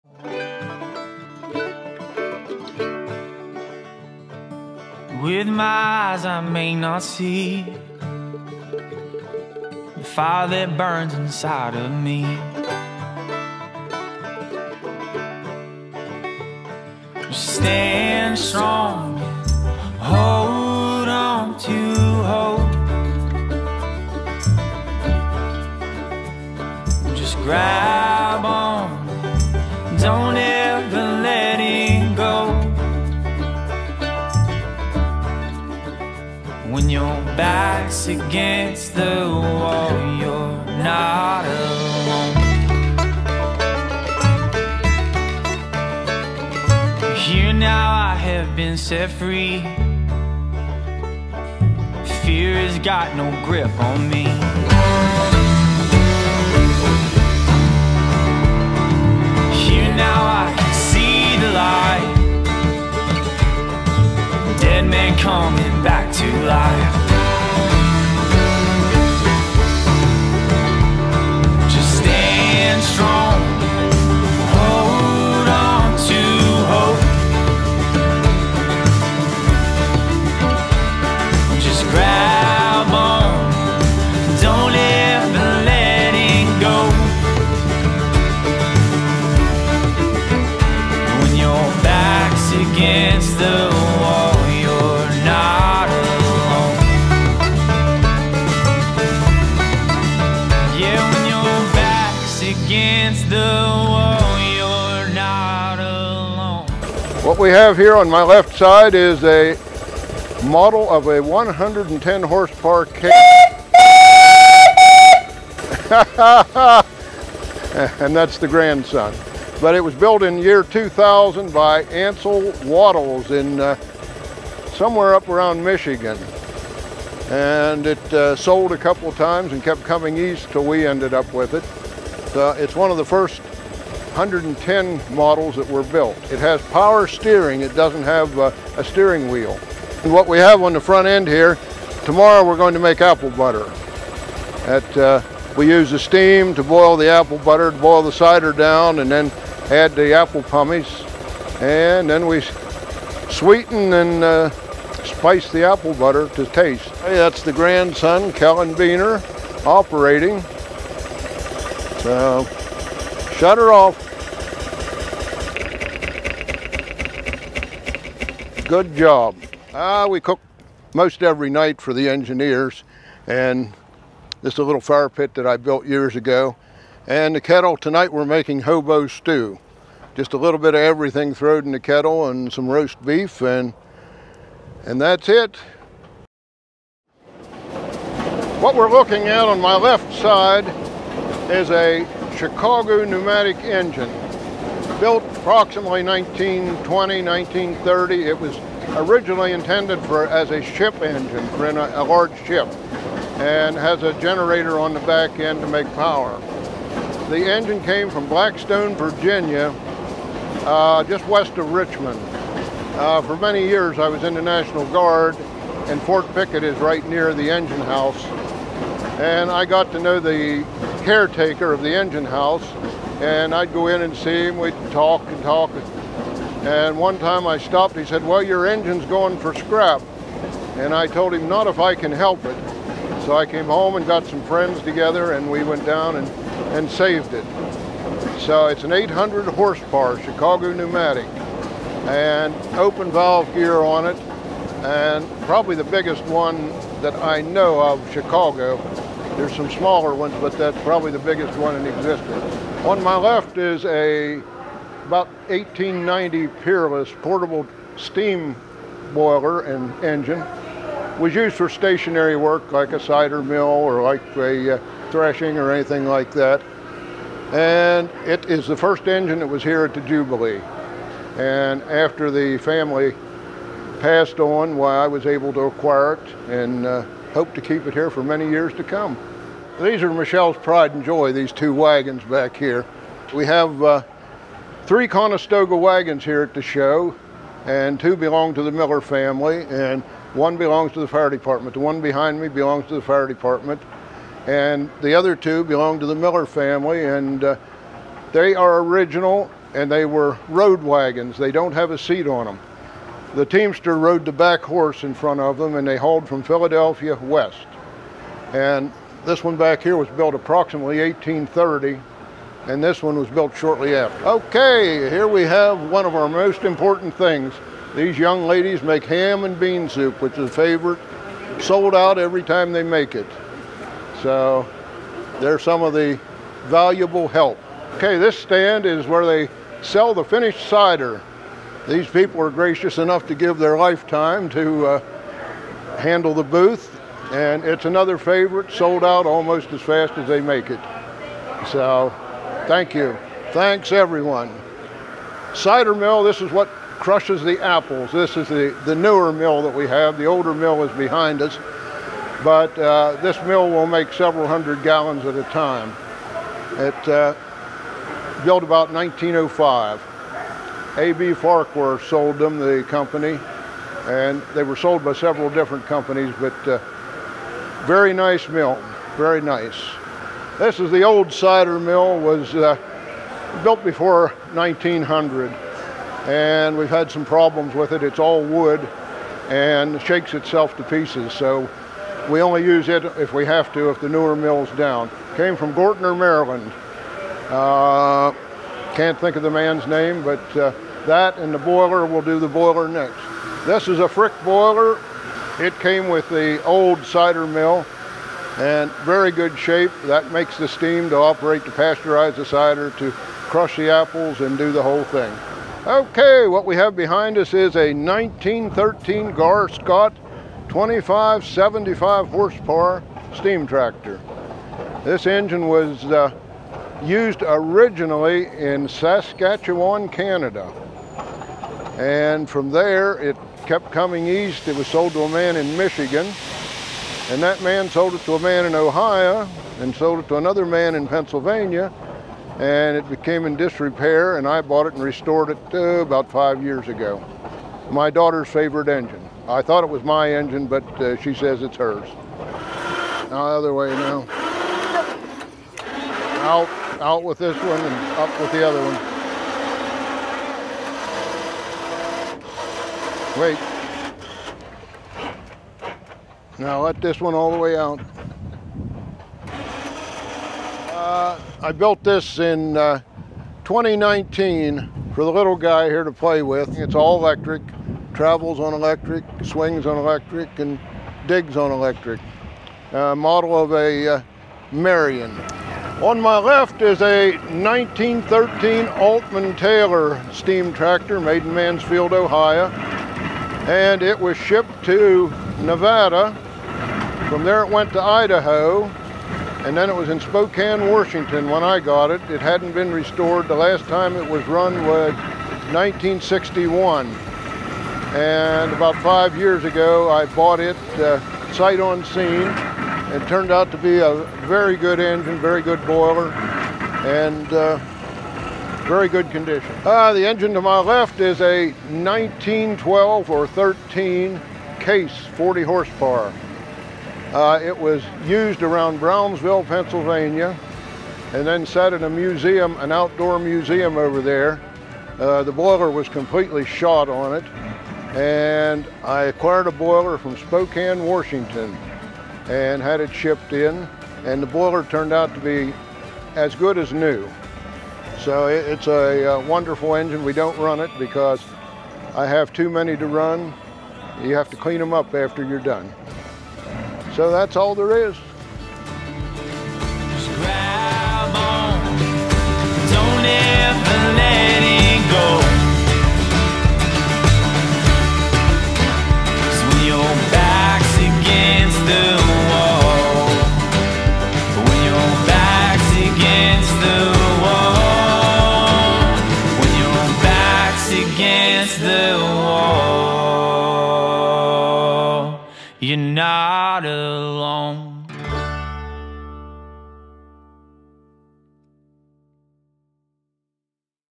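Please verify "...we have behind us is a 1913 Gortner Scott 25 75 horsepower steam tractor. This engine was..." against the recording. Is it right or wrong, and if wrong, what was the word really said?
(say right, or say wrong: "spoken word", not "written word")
wrong: "Gaar", not "Gortner".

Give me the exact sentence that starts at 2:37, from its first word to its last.
Hey, that's the grandson, Kellen Beener, operating.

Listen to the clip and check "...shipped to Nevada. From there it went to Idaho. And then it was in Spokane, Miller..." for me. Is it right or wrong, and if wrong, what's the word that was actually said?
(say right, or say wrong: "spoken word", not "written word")
wrong: "Washington", not "Miller".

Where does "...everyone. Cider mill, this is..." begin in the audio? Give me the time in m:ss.
5:43.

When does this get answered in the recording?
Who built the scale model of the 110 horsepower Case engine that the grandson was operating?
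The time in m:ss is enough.
2:01.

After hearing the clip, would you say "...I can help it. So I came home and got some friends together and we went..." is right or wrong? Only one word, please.
right.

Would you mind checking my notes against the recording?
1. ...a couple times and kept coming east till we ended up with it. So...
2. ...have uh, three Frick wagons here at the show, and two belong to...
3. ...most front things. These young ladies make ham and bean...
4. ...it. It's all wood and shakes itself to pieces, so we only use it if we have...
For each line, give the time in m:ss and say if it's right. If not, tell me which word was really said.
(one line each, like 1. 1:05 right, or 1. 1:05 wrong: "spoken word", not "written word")
1. 2:08 right
2. 4:43 wrong: "Conestoga", not "Frick"
3. 5:16 wrong: "important", not "front"
4. 6:17 right.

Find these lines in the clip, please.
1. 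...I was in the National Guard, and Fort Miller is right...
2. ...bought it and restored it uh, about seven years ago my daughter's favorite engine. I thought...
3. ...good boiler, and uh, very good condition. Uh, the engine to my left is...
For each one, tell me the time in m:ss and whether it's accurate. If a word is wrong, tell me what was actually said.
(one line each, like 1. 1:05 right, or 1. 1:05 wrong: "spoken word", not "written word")
1. 3:33 wrong: "Pickett", not "Miller"
2. 7:14 wrong: "five", not "seven"
3. 8:25 right.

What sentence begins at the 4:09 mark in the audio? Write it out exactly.
There's some smaller ones, but that's probably the biggest one in existence.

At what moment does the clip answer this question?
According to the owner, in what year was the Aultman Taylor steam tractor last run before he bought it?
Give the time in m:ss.
8:15.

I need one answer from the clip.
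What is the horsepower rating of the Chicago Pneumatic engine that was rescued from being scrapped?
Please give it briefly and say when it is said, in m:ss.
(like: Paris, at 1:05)
800, at 3:58.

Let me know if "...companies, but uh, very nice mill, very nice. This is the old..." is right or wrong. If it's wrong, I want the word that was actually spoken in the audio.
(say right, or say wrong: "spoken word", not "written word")
right.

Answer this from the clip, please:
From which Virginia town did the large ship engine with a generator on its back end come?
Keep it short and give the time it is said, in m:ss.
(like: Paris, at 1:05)
Blackstone, Virginia, at 3:28.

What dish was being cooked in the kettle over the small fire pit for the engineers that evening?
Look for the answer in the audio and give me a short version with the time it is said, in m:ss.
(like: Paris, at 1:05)
hobo stew, at 2:58.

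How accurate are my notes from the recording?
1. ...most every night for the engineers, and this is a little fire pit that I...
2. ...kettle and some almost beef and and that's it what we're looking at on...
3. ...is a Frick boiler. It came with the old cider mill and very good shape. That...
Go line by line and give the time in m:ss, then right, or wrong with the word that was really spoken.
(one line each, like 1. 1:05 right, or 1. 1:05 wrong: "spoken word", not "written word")
1. 2:50 right
2. 3:01 wrong: "roast", not "almost"
3. 6:33 right.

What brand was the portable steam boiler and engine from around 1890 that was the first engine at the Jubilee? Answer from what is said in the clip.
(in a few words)
Peerless.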